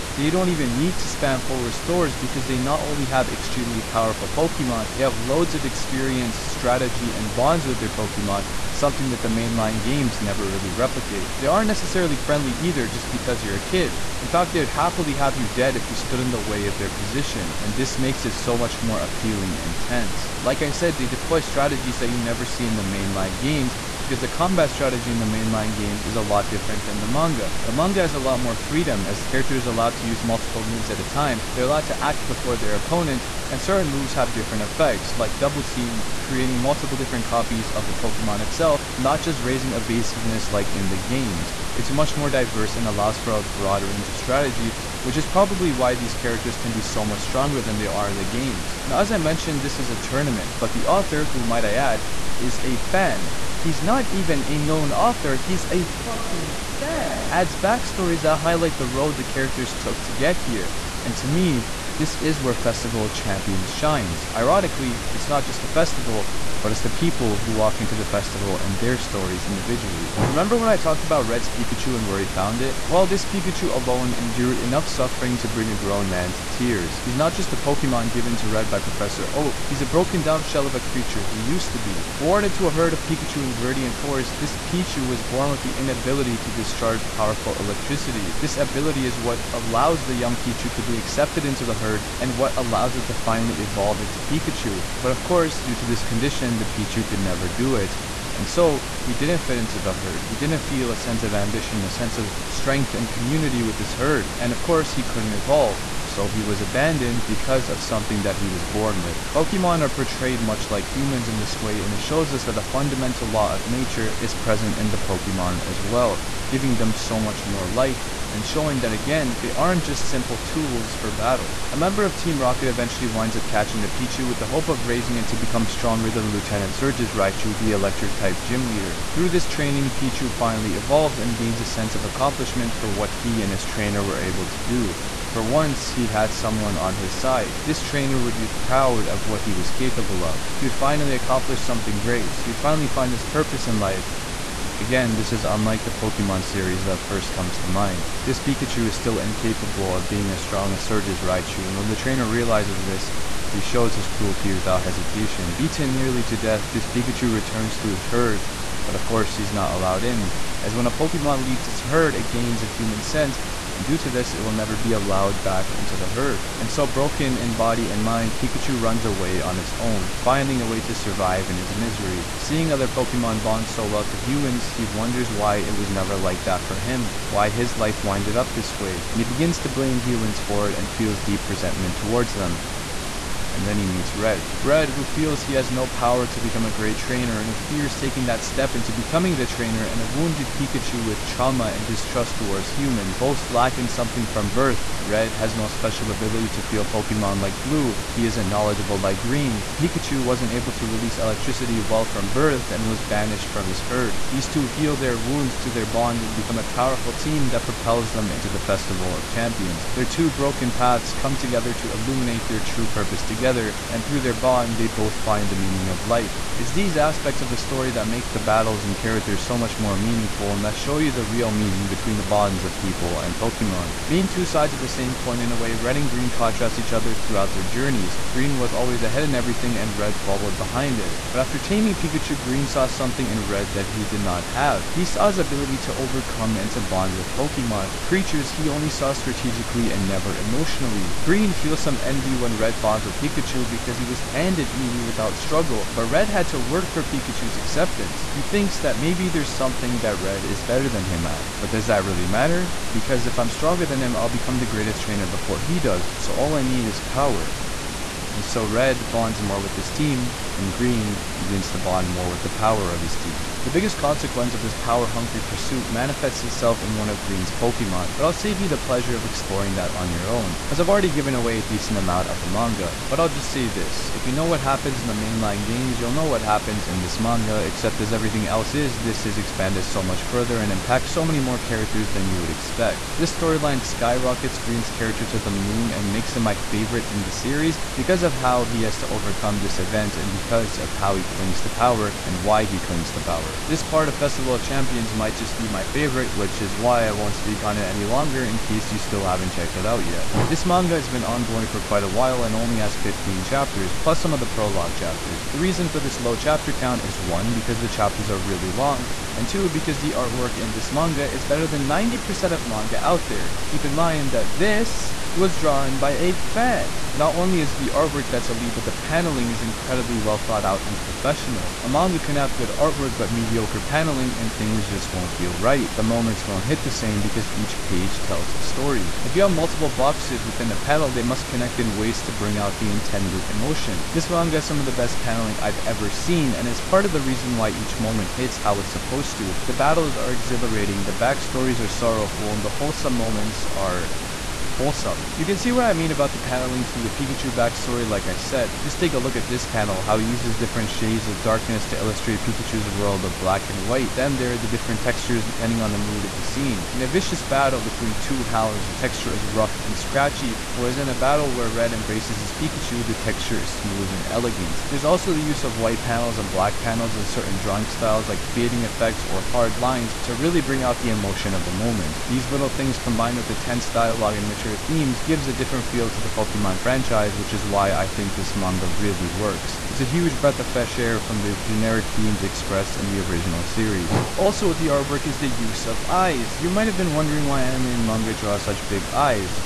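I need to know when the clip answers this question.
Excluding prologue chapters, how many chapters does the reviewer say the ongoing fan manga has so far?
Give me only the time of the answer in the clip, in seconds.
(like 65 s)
302 s.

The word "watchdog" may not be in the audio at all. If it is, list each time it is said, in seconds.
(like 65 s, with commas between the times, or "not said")
not said.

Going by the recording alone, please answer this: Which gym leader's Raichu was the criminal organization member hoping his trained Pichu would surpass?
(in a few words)
Lieutenant Surge.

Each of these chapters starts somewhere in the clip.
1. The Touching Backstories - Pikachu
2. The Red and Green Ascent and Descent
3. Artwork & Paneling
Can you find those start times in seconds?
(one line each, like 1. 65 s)
1. 49 s
2. 224 s
3. 317 s.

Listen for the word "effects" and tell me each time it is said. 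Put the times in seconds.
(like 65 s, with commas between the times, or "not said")
34 s, 368 s.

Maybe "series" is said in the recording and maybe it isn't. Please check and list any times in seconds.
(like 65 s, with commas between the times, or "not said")
146 s, 287 s, 383 s.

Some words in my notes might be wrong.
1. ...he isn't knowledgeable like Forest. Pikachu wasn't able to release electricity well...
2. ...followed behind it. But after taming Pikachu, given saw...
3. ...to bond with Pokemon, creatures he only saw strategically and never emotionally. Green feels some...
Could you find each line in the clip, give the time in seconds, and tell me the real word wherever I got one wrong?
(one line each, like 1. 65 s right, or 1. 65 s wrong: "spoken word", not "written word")
1. 198 s wrong: "Green", not "Forest"
2. 230 s wrong: "green", not "given"
3. 236 s right.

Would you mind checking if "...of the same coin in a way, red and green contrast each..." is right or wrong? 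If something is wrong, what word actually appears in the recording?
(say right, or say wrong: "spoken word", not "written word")
right.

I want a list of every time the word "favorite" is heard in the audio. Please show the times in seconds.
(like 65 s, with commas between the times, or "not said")
286 s, 295 s.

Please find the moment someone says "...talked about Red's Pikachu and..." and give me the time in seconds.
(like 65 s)
70 s.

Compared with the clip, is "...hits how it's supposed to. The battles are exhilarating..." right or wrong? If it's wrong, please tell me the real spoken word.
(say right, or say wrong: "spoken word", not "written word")
right.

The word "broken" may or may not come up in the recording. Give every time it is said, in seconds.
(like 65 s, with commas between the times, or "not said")
79 s, 166 s, 210 s.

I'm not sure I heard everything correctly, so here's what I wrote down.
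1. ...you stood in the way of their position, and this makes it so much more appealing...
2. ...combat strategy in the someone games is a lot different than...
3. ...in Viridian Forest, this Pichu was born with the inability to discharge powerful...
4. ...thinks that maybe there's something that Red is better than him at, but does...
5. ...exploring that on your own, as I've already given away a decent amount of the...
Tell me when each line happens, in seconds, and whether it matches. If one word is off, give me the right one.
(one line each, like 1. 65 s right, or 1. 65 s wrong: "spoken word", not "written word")
1. 15 s right
2. 24 s wrong: "mainline", not "someone"
3. 83 s right
4. 248 s right
5. 269 s right.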